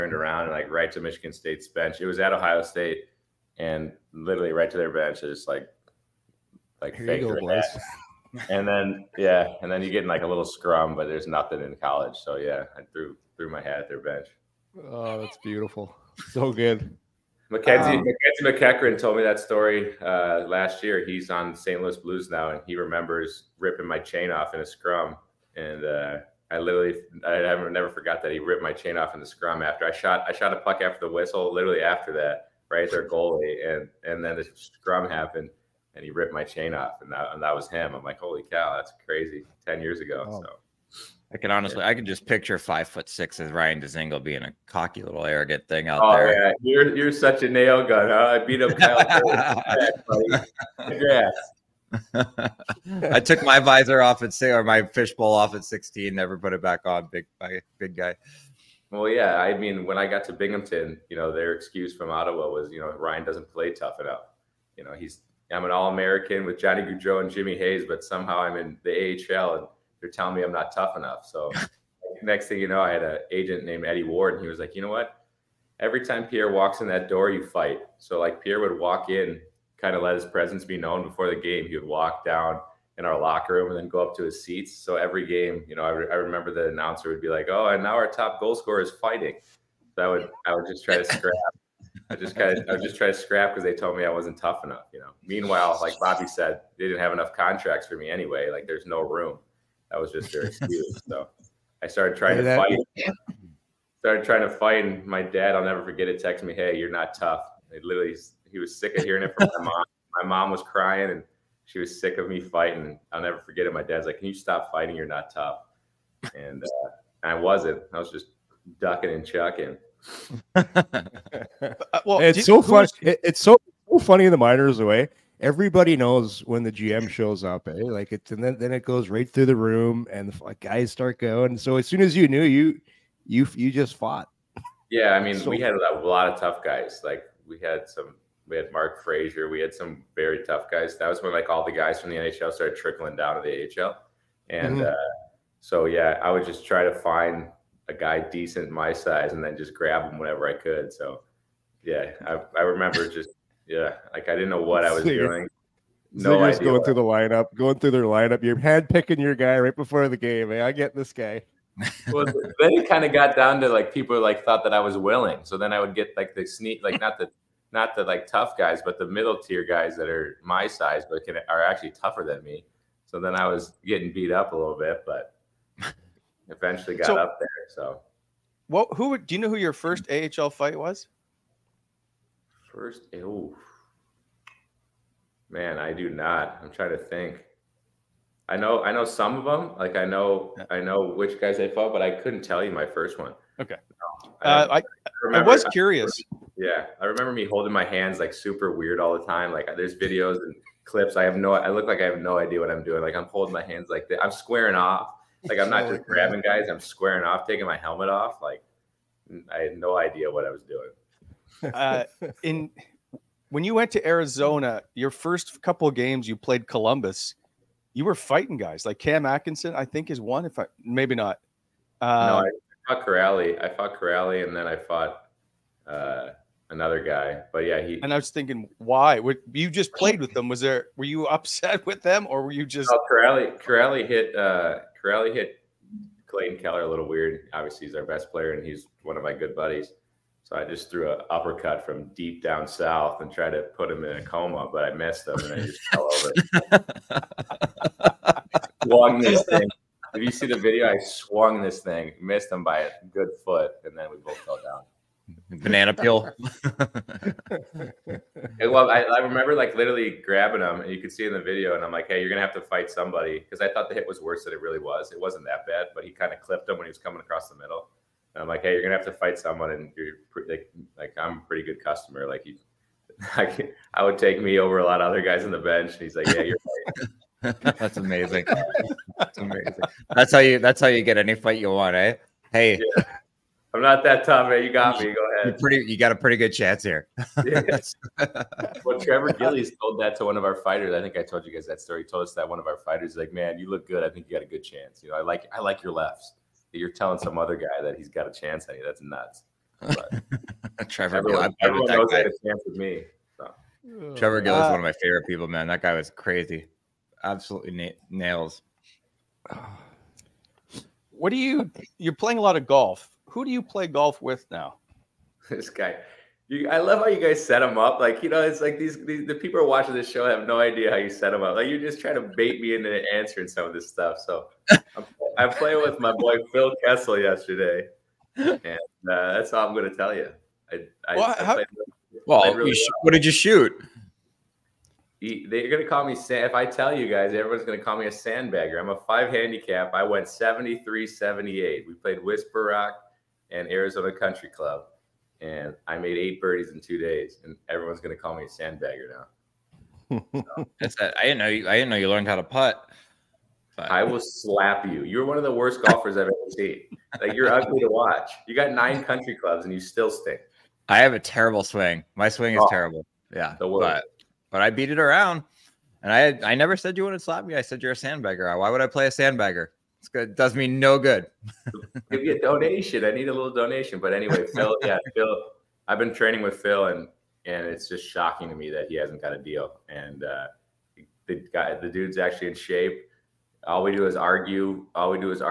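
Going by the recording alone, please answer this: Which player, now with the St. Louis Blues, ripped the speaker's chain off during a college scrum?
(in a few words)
Mackenzie MacEachern.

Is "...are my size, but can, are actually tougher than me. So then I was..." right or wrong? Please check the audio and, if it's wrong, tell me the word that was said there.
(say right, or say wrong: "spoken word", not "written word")
right.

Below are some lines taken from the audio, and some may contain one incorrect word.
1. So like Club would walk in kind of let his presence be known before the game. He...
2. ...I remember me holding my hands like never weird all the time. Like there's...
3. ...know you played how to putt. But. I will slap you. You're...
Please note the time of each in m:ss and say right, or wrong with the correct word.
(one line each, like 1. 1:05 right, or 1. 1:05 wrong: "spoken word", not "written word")
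1. 1:17 wrong: "Pierre", not "Club"
2. 3:17 wrong: "super", not "never"
3. 5:51 wrong: "learned", not "played".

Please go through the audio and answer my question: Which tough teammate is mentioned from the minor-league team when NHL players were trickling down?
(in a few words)
Mark Fraser.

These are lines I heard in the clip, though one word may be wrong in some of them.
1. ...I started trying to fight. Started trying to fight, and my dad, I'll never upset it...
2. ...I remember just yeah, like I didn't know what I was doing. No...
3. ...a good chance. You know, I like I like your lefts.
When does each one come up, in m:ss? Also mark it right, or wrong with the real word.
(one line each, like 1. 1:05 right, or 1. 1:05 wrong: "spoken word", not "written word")
1. 1:41 wrong: "forget", not "upset"
2. 2:32 right
3. 4:54 right.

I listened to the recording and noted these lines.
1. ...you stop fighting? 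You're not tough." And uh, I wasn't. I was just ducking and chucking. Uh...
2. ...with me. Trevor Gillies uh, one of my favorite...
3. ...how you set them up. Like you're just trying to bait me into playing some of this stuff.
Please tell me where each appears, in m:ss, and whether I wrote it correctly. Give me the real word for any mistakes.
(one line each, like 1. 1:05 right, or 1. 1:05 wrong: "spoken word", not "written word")
1. 1:54 right
2. 5:02 right
3. 5:20 wrong: "answering", not "playing".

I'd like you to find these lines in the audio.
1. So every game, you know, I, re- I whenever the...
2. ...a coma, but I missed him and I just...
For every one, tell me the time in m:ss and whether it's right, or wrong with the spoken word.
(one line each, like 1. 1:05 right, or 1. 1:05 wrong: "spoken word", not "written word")
1. 1:24 wrong: "remember", not "whenever"
2. 4:04 right.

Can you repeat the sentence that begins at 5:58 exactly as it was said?
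You got nine country clubs and you still stink.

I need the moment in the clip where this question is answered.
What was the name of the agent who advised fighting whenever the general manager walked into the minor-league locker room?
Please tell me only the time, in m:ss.
1:13.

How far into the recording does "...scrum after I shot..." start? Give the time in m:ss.
0:29.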